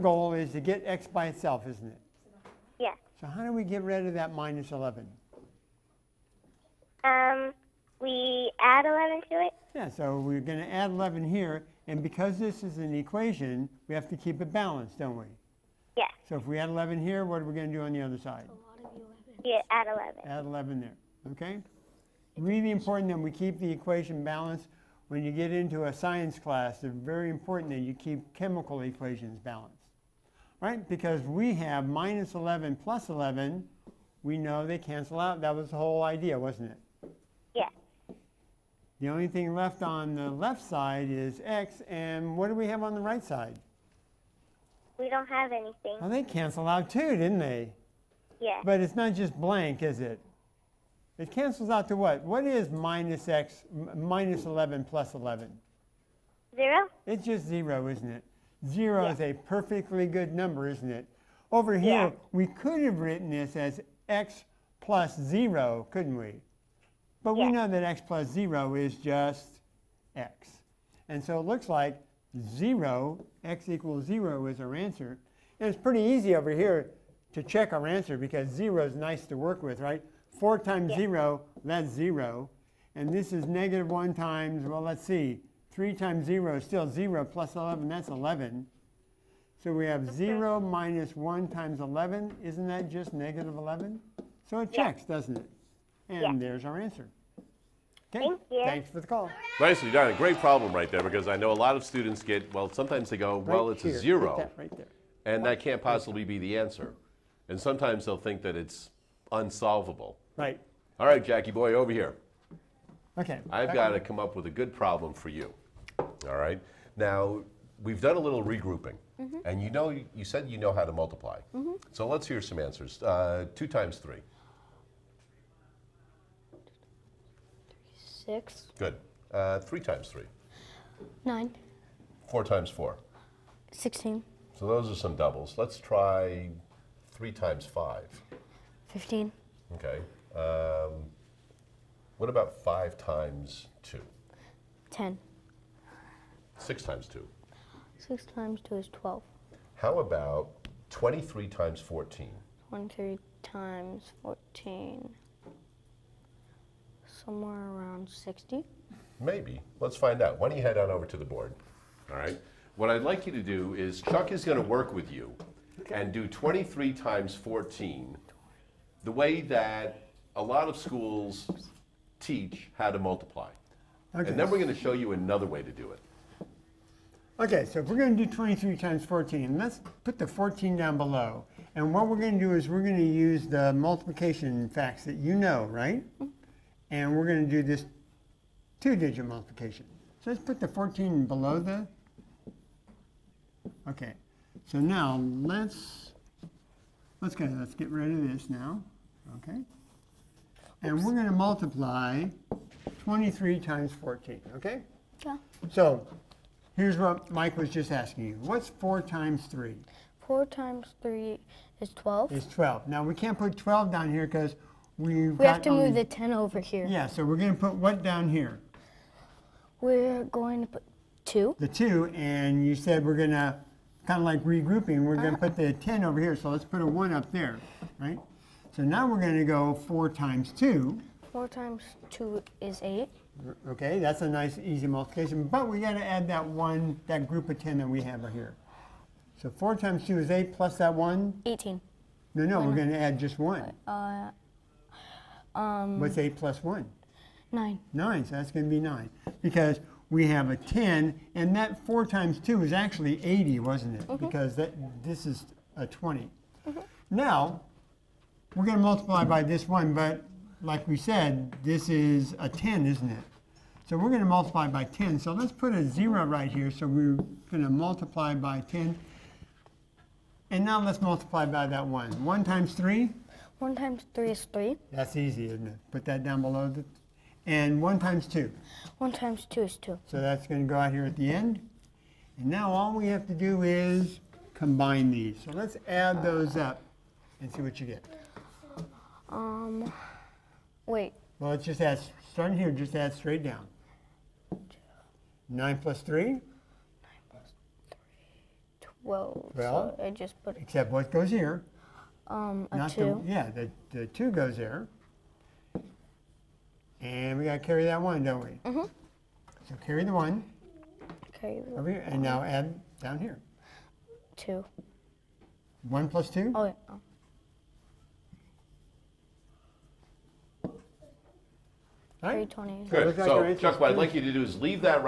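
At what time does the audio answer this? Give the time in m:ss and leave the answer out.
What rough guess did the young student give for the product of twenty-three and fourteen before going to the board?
2:37.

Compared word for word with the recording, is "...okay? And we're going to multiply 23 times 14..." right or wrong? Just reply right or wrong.
right.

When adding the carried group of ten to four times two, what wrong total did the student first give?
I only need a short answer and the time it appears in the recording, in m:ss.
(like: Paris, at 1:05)
18, at 4:01.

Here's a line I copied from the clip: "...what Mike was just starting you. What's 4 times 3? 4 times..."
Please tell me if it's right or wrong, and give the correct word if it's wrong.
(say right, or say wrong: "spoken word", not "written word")
wrong: "asking", not "starting".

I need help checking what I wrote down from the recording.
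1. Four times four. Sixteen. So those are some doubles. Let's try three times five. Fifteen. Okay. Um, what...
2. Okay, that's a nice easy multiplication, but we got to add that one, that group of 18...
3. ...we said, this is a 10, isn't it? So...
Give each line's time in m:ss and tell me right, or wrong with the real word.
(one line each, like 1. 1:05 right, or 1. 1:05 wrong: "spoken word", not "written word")
1. 2:12 right
2. 3:53 wrong: "10", not "18"
3. 4:20 right.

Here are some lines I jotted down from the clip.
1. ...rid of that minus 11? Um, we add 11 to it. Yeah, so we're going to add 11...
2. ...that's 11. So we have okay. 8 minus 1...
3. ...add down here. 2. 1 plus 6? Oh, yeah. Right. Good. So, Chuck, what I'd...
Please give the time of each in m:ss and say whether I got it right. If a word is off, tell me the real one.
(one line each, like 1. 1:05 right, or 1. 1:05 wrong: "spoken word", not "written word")
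1. 0:03 right
2. 1:27 wrong: "0", not "8"
3. 5:12 wrong: "2", not "6".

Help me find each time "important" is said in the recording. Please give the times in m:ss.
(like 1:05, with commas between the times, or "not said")
0:22, 0:27.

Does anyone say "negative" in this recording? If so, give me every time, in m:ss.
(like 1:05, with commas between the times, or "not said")
1:23, 1:33.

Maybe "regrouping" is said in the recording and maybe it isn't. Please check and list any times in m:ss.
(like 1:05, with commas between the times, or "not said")
1:58, 3:44.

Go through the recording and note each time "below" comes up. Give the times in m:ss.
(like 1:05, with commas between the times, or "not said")
3:00, 3:11, 4:36.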